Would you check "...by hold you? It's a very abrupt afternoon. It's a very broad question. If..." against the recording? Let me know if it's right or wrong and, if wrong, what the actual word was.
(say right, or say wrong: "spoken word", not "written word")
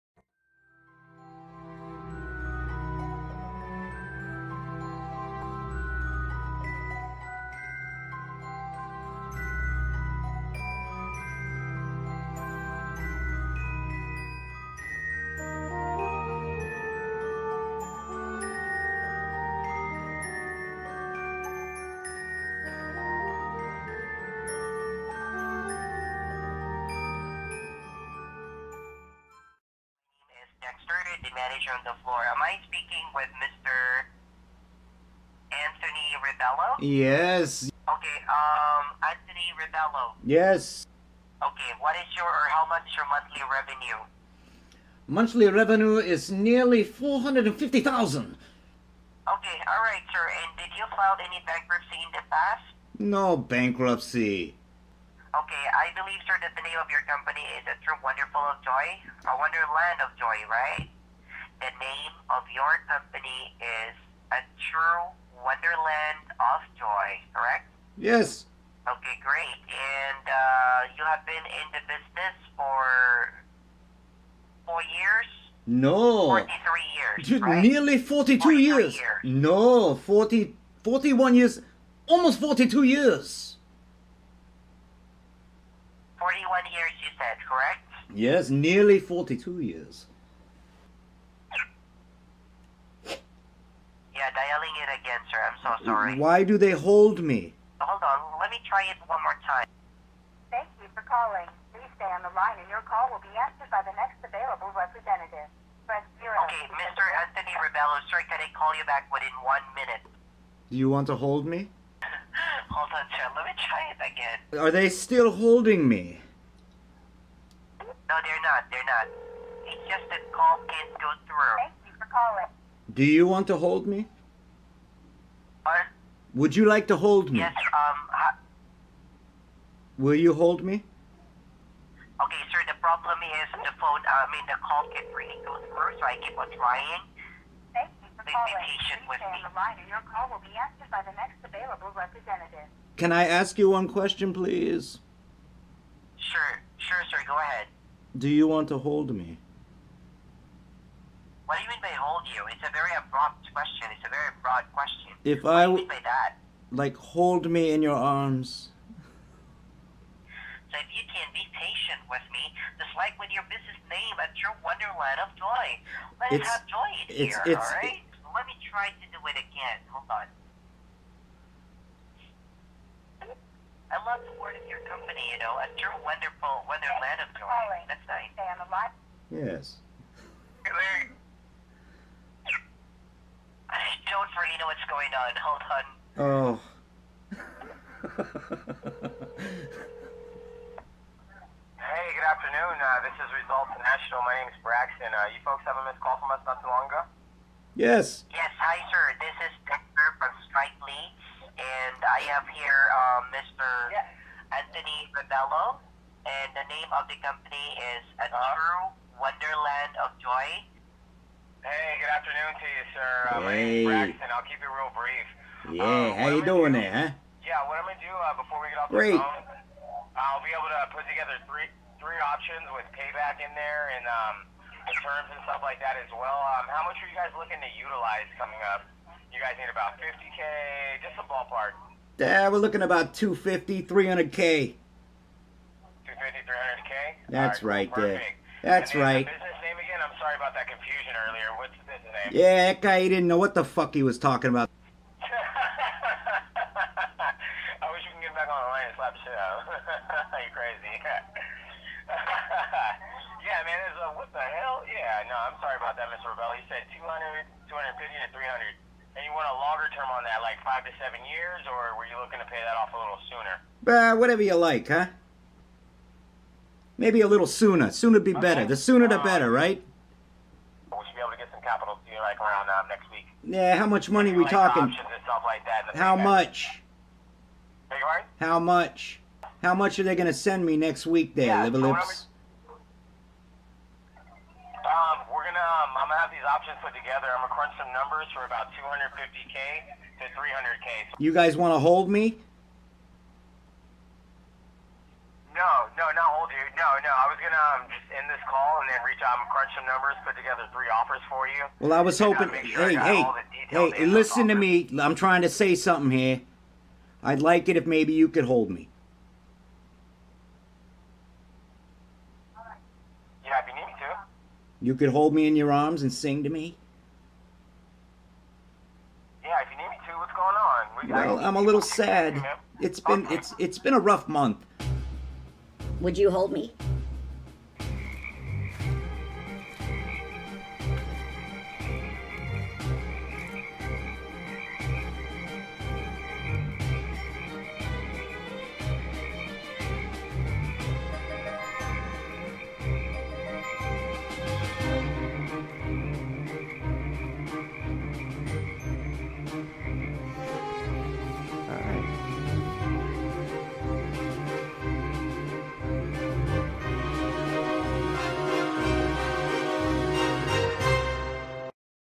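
wrong: "question", not "afternoon".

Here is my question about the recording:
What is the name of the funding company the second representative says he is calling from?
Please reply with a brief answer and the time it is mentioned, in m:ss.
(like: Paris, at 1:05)
Results National, at 3:13.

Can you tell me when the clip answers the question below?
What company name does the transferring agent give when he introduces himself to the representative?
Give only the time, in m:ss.
3:20.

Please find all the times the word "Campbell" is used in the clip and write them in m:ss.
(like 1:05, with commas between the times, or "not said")
not said.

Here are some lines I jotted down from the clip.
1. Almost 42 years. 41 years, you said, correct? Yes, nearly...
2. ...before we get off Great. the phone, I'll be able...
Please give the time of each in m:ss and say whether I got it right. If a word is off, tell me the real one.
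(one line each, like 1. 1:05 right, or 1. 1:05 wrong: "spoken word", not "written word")
1. 1:22 right
2. 3:38 right.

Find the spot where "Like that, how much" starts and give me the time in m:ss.
4:34.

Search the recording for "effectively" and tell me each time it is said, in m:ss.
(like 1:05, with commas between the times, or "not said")
not said.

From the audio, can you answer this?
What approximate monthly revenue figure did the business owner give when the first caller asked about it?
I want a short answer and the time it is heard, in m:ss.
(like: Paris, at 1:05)
450000, at 0:46.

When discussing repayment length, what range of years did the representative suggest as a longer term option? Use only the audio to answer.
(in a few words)
5 to 7 years.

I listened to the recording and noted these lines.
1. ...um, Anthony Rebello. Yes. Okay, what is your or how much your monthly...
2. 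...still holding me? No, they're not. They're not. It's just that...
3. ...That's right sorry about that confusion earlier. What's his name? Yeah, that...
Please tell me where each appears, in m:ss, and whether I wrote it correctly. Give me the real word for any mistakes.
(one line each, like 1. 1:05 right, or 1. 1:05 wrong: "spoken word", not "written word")
1. 0:38 right
2. 1:54 right
3. 3:58 right.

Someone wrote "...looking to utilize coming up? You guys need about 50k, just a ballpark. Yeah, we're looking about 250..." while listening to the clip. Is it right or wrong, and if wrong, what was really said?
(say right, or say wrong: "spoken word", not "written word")
right.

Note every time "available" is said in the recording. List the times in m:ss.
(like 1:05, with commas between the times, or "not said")
1:44, 2:21.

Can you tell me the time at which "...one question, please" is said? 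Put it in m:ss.
2:23.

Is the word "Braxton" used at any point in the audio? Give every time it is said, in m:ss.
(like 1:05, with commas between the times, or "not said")
3:14, 3:34.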